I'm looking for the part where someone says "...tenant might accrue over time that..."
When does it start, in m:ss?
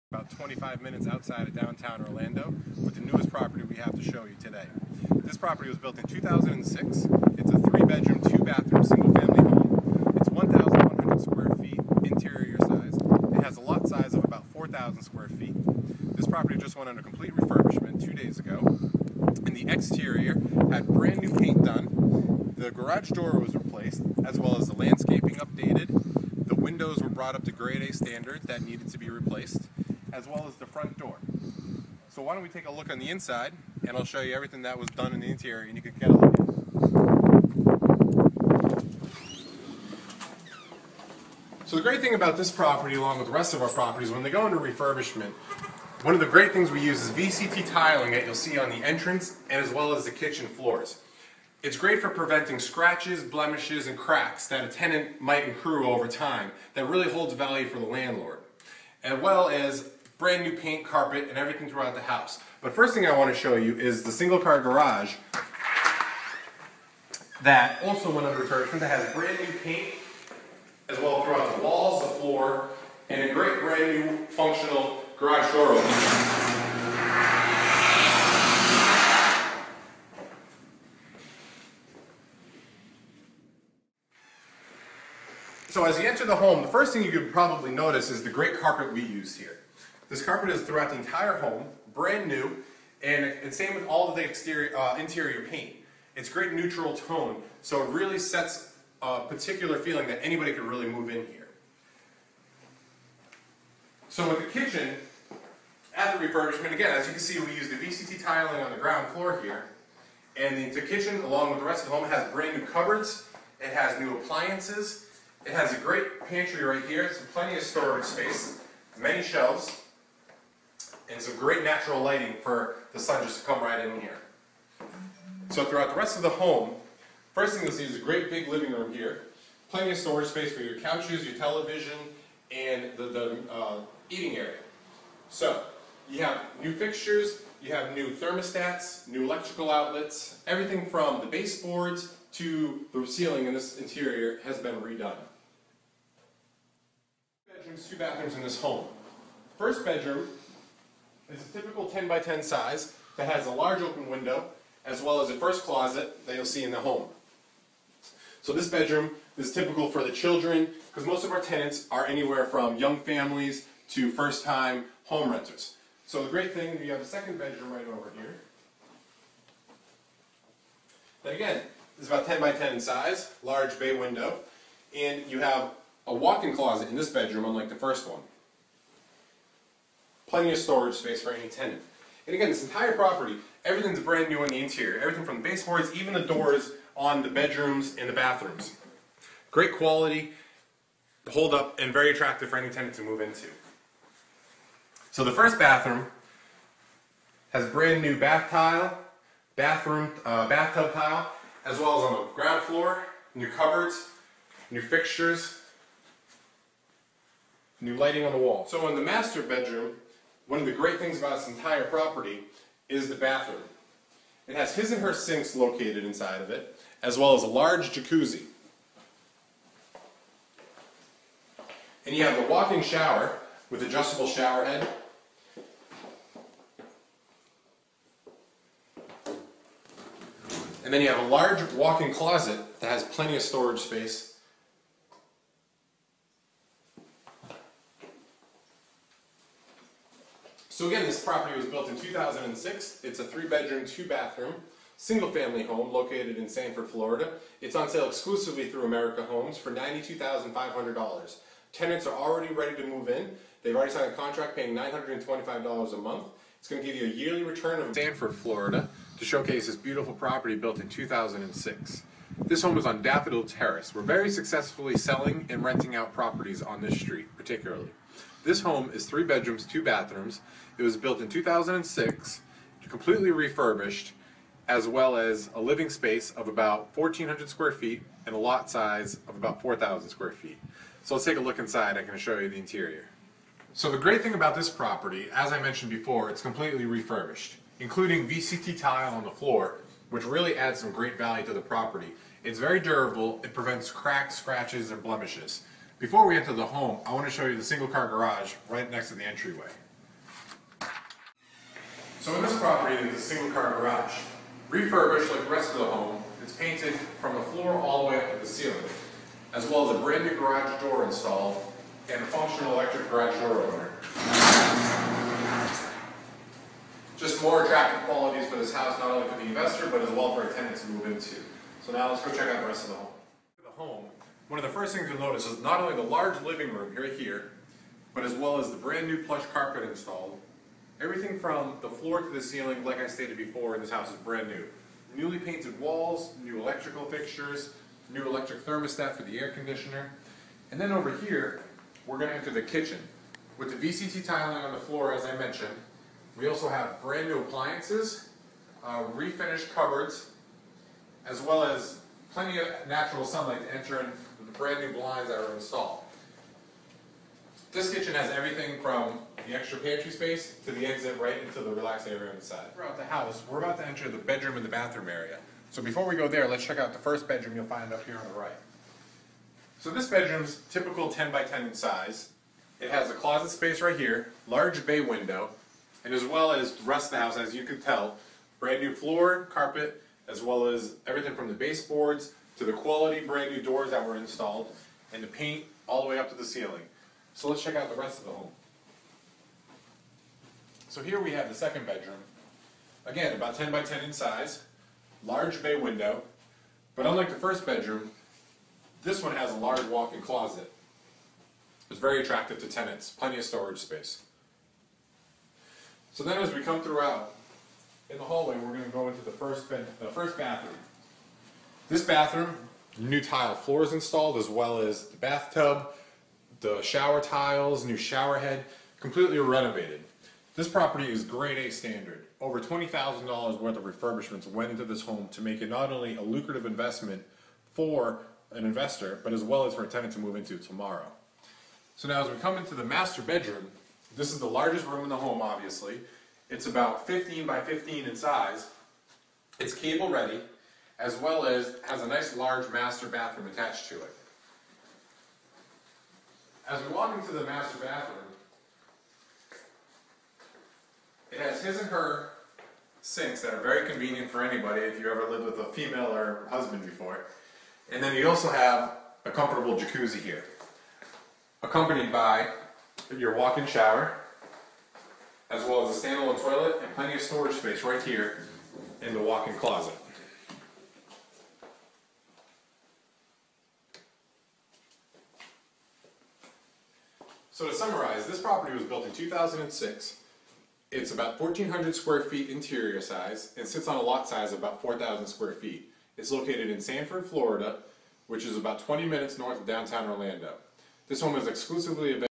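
0:54.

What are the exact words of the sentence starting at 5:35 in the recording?
Newly painted walls, new electrical fixtures, new electric thermostat for the air conditioner.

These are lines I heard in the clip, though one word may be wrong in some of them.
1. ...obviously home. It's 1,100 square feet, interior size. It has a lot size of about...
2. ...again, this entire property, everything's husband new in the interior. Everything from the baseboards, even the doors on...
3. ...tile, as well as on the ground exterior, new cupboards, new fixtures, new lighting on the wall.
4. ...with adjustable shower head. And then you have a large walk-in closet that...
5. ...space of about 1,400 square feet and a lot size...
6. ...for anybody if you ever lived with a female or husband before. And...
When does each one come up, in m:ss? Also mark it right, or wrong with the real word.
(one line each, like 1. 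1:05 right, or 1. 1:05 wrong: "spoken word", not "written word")
1. 0:09 wrong: "family", not "obviously"
2. 3:02 wrong: "brand", not "husband"
3. 3:20 wrong: "floor", not "exterior"
4. 3:43 right
5. 4:35 right
6. 7:34 right.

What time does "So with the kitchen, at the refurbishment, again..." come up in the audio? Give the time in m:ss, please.
1:44.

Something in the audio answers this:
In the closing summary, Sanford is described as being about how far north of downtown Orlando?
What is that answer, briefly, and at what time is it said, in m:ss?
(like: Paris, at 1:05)
20 minutes, at 8:08.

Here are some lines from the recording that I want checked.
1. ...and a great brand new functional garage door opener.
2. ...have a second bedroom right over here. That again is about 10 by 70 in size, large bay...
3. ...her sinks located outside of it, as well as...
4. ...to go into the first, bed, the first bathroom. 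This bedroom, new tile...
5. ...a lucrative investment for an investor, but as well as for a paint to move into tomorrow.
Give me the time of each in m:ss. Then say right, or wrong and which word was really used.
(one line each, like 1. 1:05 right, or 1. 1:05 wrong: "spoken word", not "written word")
1. 1:13 right
2. 2:46 wrong: "10", not "70"
3. 3:35 wrong: "inside", not "outside"
4. 6:48 wrong: "bathroom", not "bedroom"
5. 7:06 wrong: "tenant", not "paint".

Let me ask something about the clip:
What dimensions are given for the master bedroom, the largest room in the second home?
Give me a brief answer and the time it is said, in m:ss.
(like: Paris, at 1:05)
15 by 15, at 7:17.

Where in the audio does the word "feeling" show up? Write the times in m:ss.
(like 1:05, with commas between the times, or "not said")
1:39.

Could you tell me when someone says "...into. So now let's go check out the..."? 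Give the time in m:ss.
5:21.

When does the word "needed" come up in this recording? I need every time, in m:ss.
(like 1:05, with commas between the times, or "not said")
0:28.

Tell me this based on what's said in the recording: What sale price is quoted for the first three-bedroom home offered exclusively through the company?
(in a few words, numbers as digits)
$92,500.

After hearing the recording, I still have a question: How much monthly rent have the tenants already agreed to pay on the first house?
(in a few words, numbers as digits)
$925.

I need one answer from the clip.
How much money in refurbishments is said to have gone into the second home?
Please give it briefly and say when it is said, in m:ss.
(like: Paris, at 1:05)
Over $20,000, at 7:02.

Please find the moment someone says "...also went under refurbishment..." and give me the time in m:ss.
1:07.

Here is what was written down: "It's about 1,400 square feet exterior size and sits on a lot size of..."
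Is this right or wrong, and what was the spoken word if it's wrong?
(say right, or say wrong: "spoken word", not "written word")
wrong: "interior", not "exterior".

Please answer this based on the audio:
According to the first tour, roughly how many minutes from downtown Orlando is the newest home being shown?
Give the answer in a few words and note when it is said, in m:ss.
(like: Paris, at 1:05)
25 minutes, at 0:00.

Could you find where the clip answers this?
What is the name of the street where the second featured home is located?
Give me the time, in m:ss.
4:23.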